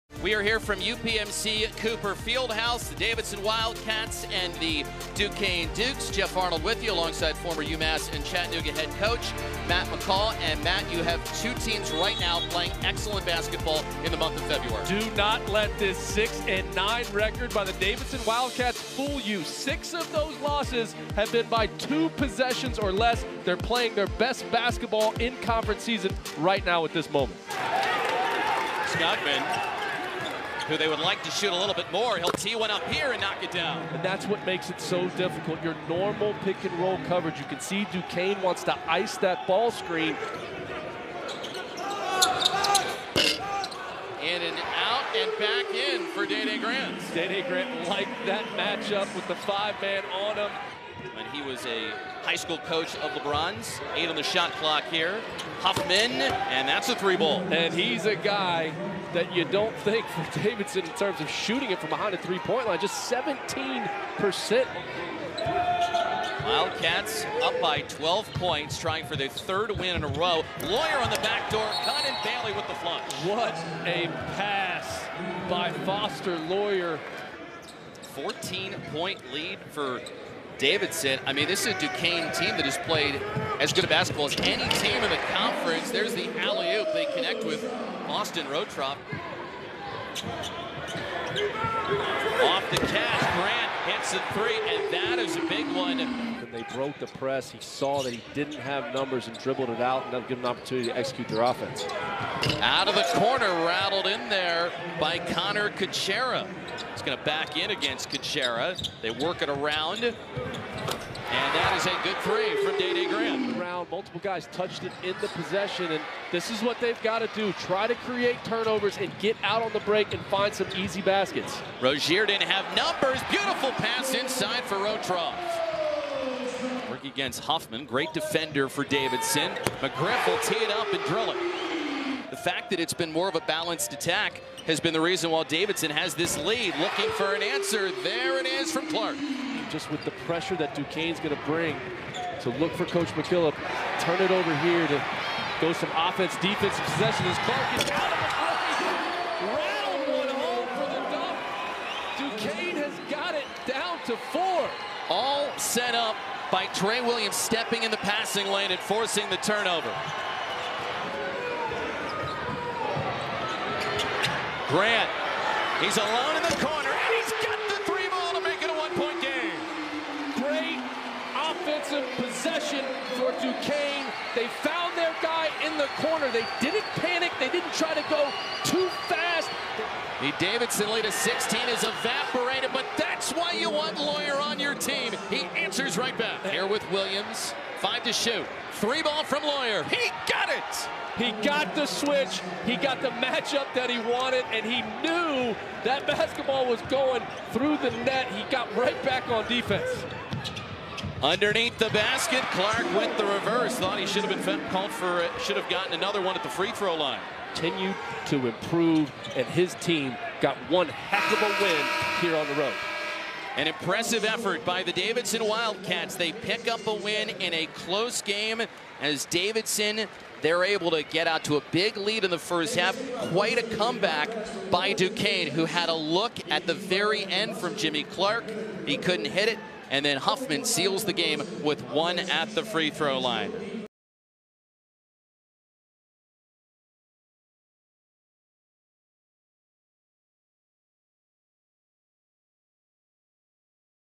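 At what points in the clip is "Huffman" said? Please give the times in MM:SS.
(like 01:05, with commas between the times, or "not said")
00:55, 02:07, 03:50.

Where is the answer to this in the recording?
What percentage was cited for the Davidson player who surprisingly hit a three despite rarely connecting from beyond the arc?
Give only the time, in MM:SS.
01:03.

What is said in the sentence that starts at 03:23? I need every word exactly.
Thought he should have been called for, should have gotten another one at the free throw line.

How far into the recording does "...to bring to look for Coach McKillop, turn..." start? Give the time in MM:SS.
02:21.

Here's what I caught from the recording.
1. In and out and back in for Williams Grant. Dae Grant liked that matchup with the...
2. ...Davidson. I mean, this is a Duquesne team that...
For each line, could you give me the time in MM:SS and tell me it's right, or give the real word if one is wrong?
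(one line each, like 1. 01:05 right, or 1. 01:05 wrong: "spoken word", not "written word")
1. 00:44 wrong: "Dae", not "Williams"
2. 01:20 right.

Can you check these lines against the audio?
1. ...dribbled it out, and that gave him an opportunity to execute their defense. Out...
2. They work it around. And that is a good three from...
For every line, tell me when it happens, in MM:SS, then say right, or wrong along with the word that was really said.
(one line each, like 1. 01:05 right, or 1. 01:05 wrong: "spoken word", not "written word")
1. 01:39 wrong: "offense", not "defense"
2. 01:49 right.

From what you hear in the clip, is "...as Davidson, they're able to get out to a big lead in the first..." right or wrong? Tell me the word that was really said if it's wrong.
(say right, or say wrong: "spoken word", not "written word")
right.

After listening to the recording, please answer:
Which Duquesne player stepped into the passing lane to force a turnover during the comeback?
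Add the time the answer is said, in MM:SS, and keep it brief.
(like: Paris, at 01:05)
Tre Williams, at 02:36.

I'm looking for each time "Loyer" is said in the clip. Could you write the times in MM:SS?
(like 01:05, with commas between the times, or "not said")
01:10, 01:16, 03:03, 03:09.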